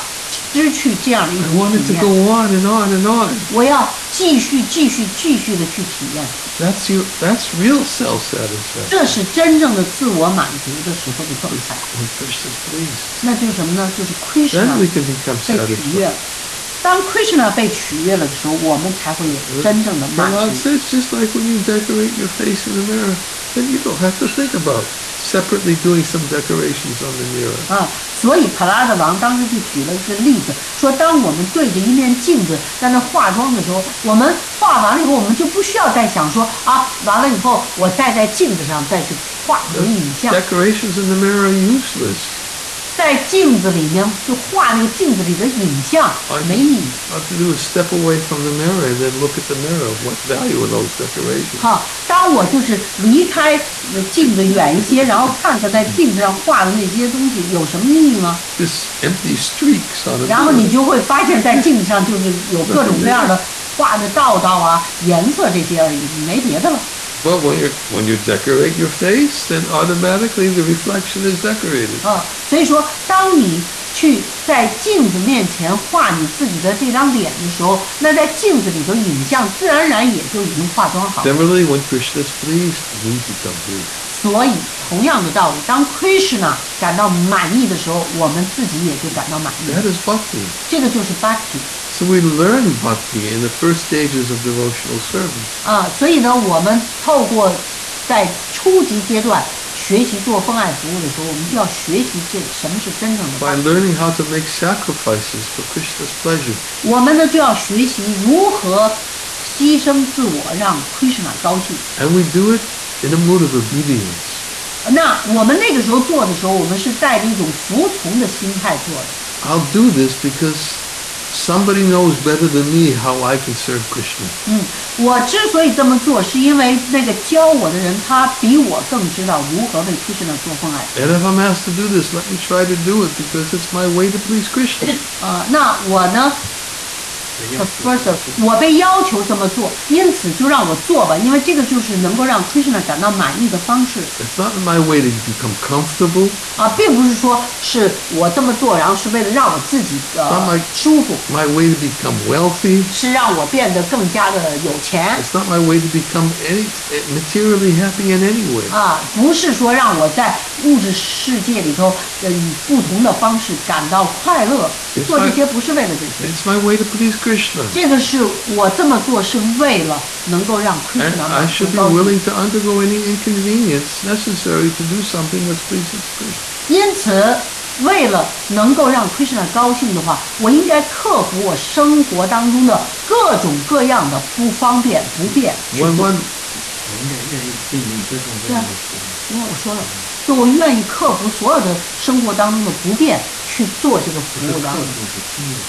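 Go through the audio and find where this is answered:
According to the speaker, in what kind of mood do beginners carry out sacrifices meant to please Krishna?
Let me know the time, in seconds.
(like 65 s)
113 s.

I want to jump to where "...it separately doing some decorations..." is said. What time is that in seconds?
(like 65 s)
24 s.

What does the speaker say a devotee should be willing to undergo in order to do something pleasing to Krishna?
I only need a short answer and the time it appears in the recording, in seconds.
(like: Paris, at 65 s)
any inconvenience, at 172 s.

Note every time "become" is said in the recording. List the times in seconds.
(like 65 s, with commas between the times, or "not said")
83 s, 145 s, 151 s, 155 s.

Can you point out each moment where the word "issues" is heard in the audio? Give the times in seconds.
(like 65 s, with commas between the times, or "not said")
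not said.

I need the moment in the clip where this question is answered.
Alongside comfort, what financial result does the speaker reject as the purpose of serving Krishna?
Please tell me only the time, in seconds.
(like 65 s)
152 s.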